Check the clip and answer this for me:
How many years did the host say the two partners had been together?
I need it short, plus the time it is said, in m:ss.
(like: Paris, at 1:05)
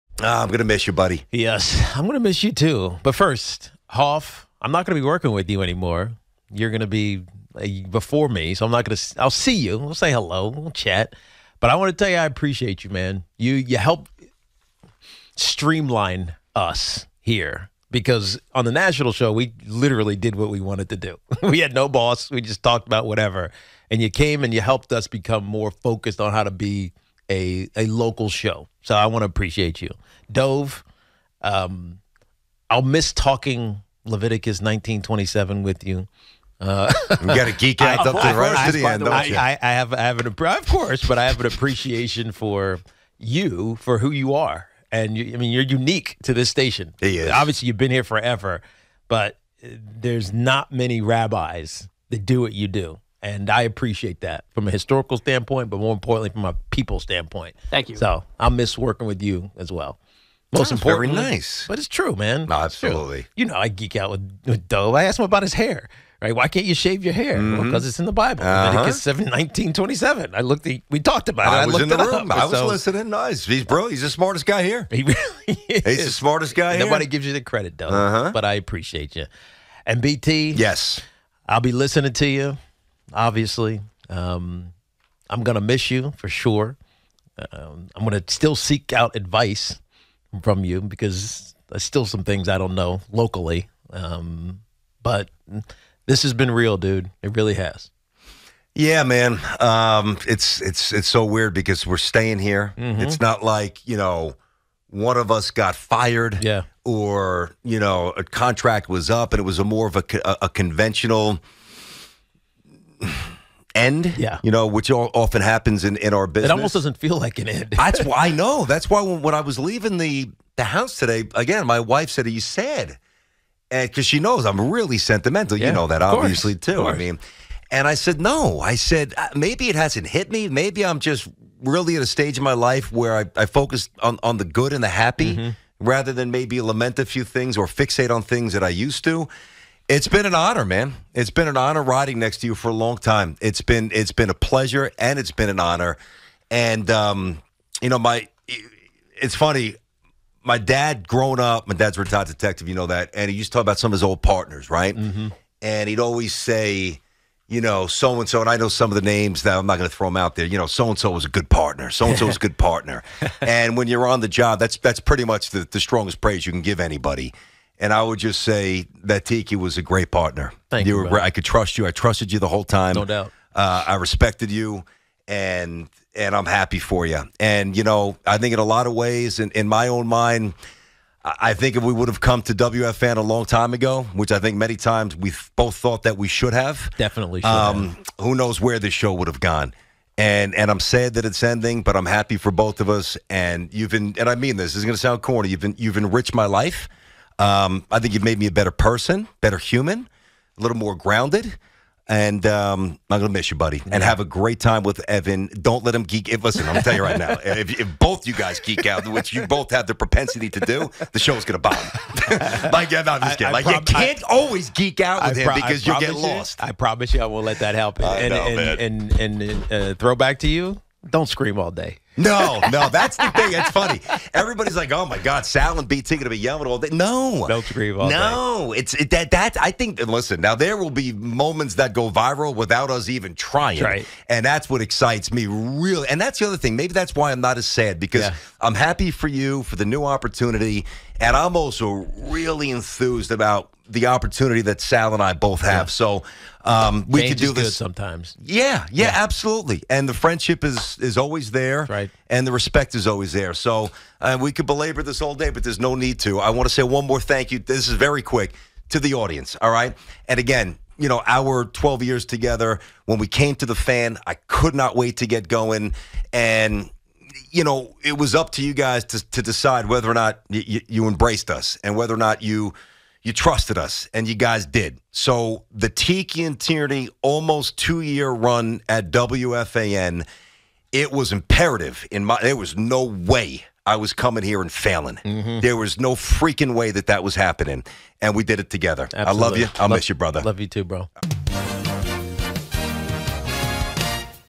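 12, at 4:21.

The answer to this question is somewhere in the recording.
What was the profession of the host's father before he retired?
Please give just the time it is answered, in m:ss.
2:32.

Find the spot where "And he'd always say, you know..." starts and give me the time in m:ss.
2:35.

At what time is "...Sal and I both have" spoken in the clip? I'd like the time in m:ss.
4:04.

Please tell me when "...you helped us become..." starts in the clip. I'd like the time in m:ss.
0:24.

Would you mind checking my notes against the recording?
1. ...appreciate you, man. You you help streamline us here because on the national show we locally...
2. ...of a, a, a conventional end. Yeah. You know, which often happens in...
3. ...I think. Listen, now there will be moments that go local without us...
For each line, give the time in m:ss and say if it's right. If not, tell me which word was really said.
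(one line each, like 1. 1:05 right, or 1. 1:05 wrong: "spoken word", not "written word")
1. 0:12 wrong: "literally", not "locally"
2. 1:49 right
3. 3:49 wrong: "viral", not "local".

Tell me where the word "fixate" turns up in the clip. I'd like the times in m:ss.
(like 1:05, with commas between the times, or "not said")
2:17.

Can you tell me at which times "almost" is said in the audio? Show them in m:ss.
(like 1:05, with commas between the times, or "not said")
1:56, 4:37.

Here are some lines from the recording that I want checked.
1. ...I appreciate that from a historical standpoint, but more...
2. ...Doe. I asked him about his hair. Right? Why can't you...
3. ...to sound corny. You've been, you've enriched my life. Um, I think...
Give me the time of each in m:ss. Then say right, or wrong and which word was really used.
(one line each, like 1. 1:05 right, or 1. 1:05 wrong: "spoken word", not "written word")
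1. 0:53 right
2. 1:04 right
3. 3:14 right.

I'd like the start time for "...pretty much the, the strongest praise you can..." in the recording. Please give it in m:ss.
2:44.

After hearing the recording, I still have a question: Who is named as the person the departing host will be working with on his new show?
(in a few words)
Evan.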